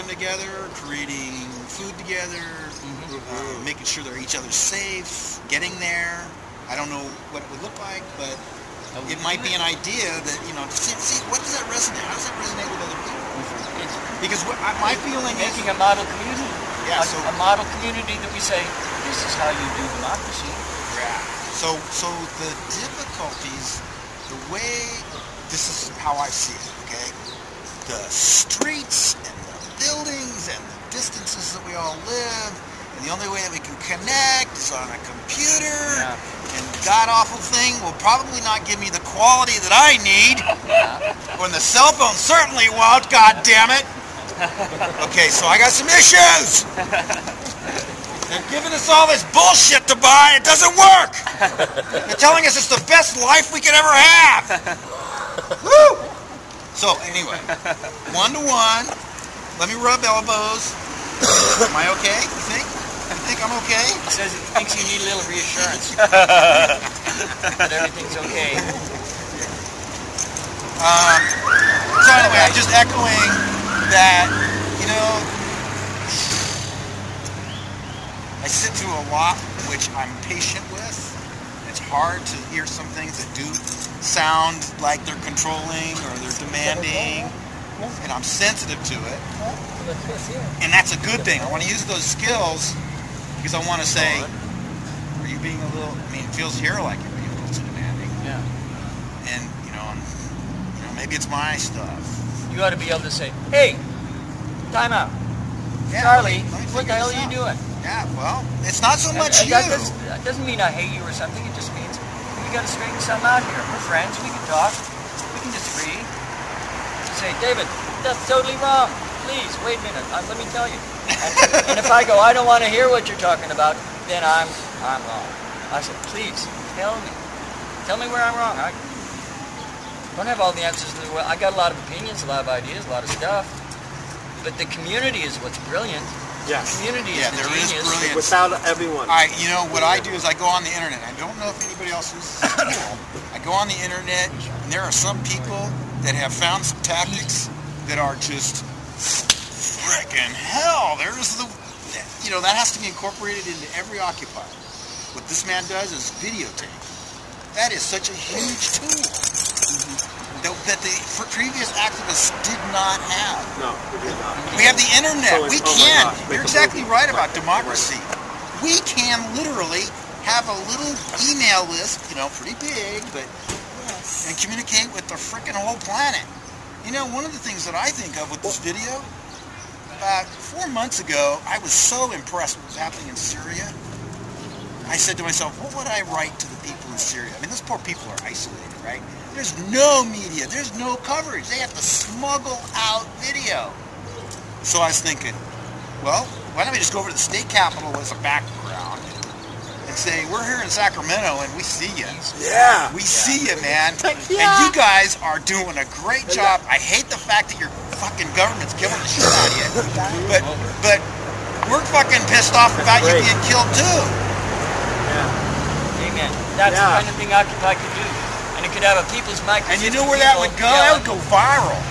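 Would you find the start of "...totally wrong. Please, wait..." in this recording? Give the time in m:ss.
1:58.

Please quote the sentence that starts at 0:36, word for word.
and god awful thing will probably not give me the quality that I need, yeah.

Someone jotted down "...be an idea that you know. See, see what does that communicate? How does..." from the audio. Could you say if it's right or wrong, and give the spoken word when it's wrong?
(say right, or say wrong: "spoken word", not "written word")
wrong: "resonate", not "communicate".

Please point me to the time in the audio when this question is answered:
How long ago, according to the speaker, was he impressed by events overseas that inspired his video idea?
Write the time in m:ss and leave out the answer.
3:00.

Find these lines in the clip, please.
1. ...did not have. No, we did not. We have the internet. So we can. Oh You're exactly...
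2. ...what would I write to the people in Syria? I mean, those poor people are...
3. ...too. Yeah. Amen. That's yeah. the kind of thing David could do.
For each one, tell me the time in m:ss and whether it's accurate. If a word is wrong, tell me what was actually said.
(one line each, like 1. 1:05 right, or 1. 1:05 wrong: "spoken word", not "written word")
1. 2:42 right
2. 3:05 right
3. 3:33 wrong: "Occupy", not "David".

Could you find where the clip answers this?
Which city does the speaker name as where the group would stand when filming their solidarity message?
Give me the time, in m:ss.
3:20.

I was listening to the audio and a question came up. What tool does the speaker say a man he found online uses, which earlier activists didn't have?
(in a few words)
Videotape.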